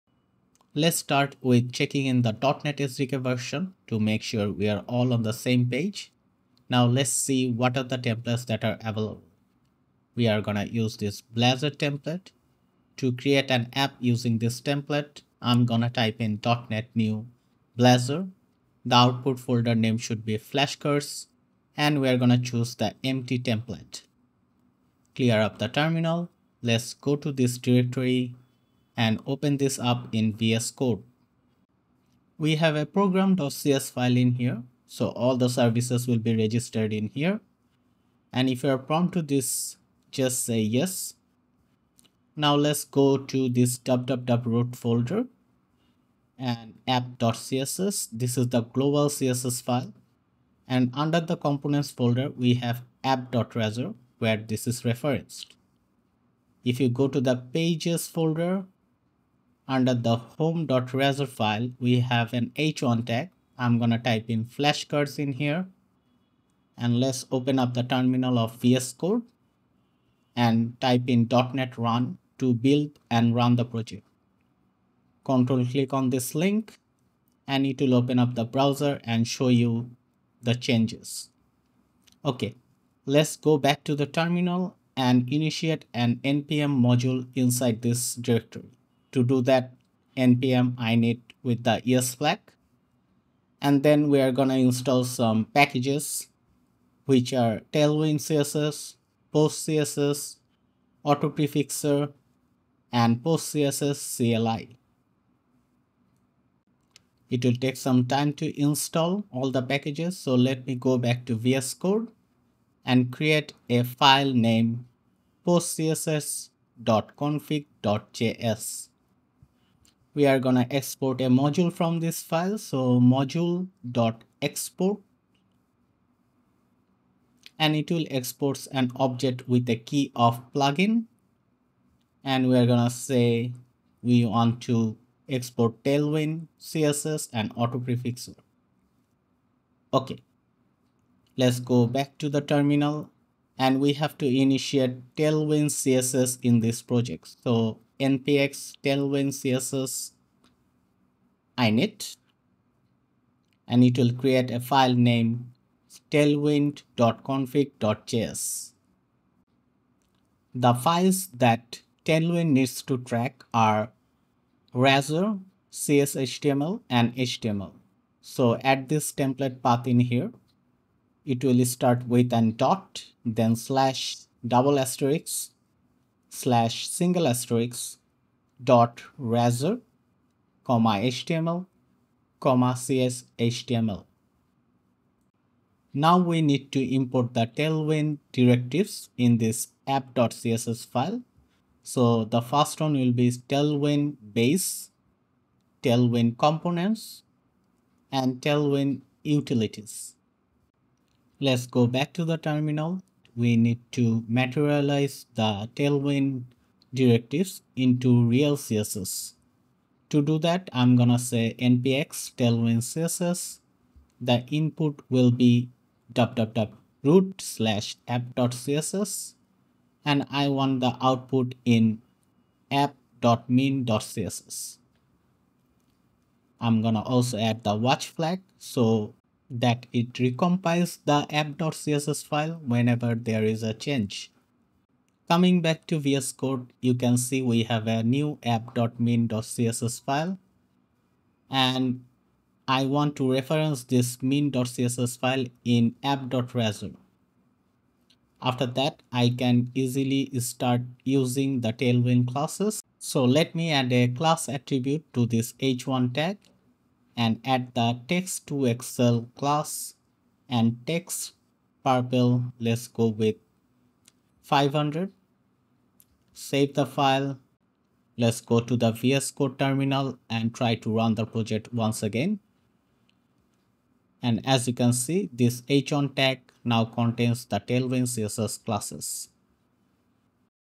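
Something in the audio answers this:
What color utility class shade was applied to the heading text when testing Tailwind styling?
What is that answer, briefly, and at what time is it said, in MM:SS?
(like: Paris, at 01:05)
purple 500, at 04:20.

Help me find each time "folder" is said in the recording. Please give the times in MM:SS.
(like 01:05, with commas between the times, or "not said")
00:19, 00:44, 00:51, 00:58.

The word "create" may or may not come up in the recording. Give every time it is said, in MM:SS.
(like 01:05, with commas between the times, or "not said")
00:13, 01:53, 02:34.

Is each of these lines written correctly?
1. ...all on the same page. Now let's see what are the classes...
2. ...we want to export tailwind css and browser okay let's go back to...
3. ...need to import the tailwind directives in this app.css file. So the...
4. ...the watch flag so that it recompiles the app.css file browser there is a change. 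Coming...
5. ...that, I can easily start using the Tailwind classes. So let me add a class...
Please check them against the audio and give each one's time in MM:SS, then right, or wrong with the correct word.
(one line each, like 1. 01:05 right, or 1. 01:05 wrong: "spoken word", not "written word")
1. 00:04 wrong: "templates", not "classes"
2. 02:14 wrong: "autoprefixer", not "browser"
3. 03:06 right
4. 03:47 wrong: "whenever", not "browser"
5. 04:08 right.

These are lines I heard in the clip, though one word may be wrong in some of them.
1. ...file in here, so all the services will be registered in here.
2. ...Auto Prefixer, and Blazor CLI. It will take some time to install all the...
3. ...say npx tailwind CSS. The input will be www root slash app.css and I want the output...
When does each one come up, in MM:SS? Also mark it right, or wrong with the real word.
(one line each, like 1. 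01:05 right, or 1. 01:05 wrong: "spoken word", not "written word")
1. 00:33 right
2. 01:41 wrong: "PostCSS", not "Blazor"
3. 03:31 right.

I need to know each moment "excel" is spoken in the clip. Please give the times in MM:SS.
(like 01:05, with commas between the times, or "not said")
04:18.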